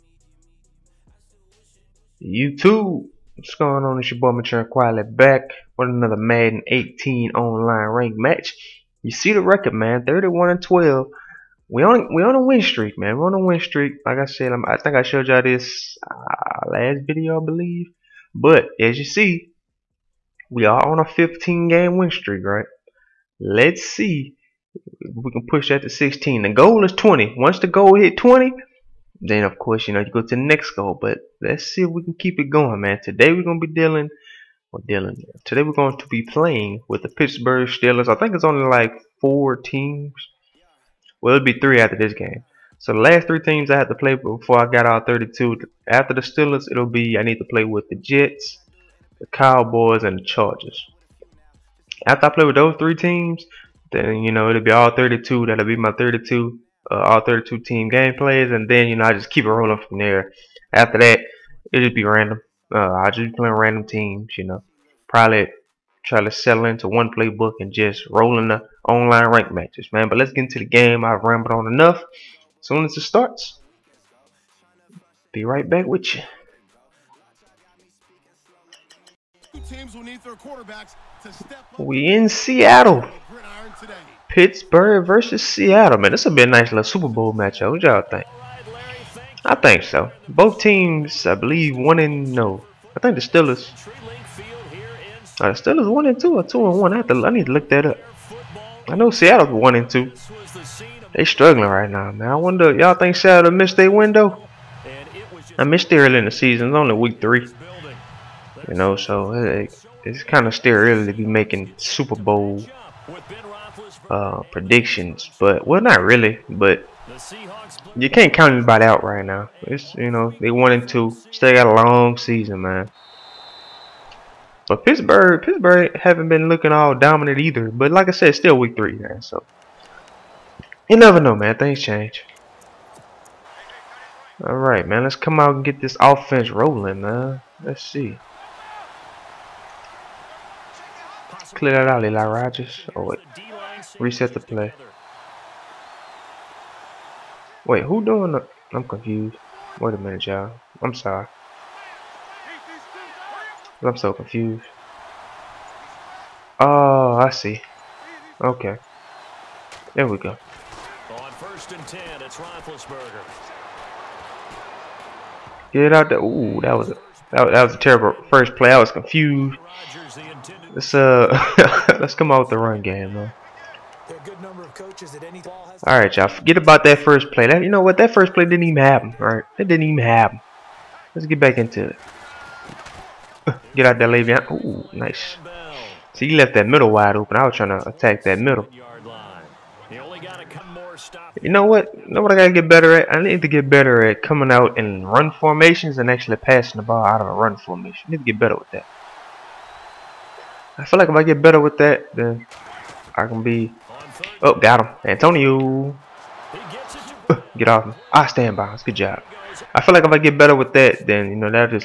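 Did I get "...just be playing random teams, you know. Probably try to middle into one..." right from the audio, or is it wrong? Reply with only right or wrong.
wrong.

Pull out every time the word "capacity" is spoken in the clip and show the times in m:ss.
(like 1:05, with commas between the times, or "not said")
not said.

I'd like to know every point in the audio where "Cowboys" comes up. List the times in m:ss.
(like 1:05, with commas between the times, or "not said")
0:49.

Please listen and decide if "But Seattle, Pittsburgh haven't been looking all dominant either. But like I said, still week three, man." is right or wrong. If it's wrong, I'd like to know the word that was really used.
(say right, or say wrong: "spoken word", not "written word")
wrong: "Pittsburgh", not "Seattle".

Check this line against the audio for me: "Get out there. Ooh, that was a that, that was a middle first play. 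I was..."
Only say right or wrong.
wrong.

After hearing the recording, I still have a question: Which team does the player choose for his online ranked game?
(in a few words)
Pittsburgh Steelers.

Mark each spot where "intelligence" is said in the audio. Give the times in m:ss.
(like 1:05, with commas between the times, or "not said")
not said.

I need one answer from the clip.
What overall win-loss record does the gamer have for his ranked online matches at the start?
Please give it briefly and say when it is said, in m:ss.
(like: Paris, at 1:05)
31-12, at 0:10.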